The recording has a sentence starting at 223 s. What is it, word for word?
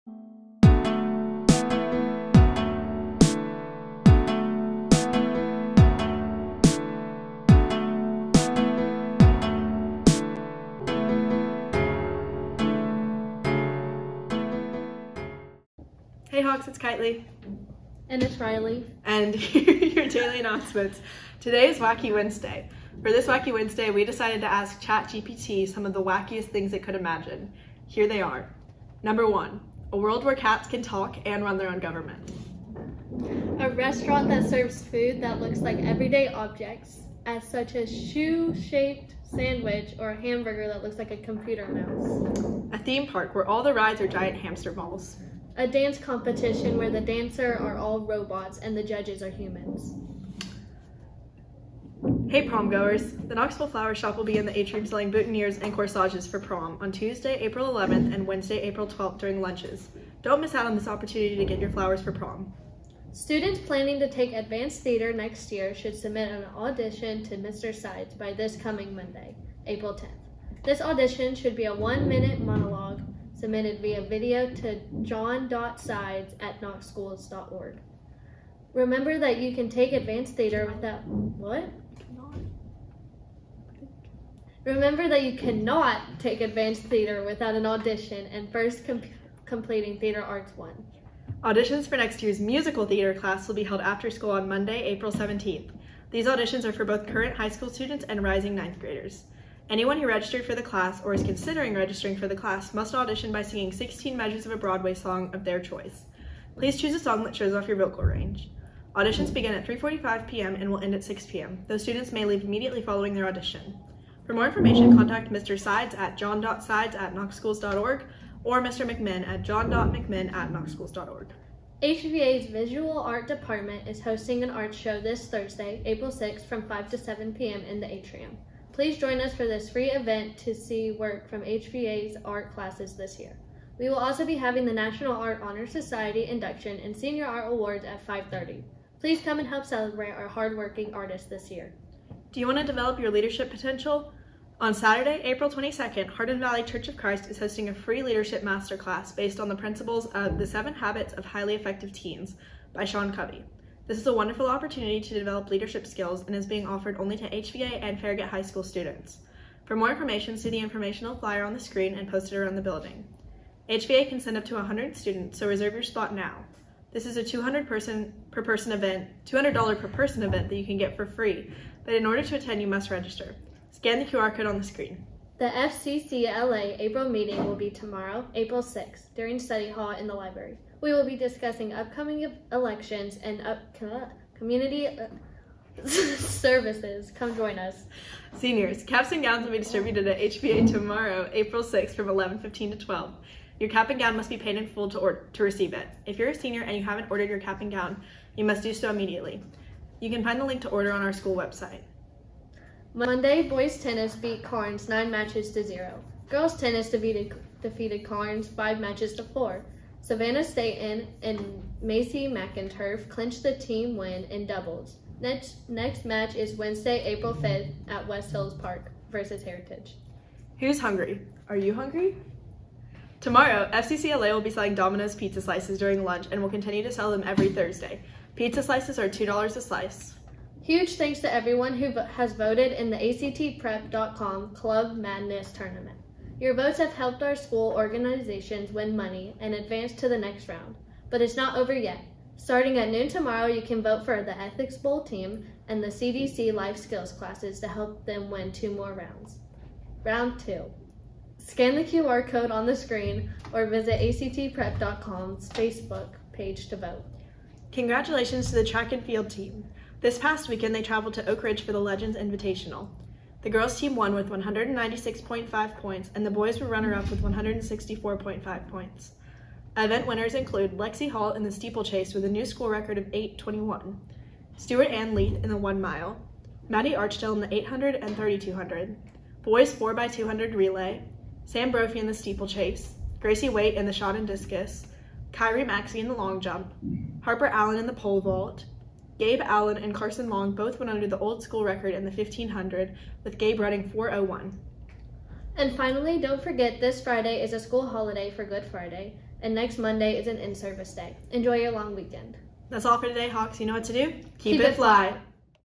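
Tomorrow, FCCLA will be selling Domino's pizza slices during lunch and will continue to sell them every Thursday.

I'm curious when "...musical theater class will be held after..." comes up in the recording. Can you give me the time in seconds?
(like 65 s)
92 s.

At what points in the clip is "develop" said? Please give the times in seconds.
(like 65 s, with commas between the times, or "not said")
142 s, 155 s.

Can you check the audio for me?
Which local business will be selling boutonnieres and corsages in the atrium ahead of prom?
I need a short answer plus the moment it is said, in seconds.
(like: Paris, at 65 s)
Knoxville Flower Shop, at 53 s.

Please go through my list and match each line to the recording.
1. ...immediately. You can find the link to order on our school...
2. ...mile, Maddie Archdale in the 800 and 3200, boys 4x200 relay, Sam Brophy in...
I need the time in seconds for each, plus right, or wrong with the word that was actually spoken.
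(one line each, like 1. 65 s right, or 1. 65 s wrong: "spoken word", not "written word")
1. 198 s right
2. 275 s right.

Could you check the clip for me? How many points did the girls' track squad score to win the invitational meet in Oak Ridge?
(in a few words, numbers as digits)
196.5.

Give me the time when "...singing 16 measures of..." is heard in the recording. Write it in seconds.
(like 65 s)
103 s.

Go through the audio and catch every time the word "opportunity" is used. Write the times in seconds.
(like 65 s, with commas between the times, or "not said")
60 s, 154 s.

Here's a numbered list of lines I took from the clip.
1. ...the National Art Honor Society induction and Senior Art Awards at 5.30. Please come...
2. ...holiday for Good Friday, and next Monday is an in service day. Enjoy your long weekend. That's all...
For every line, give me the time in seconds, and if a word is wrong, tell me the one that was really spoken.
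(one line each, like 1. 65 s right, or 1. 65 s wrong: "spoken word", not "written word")
1. 134 s right
2. 297 s right.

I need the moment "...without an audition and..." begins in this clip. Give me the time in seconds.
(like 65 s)
87 s.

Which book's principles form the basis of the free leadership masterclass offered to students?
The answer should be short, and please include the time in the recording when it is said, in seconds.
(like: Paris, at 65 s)
The Seven Habits of Highly Effective Teens, at 150 s.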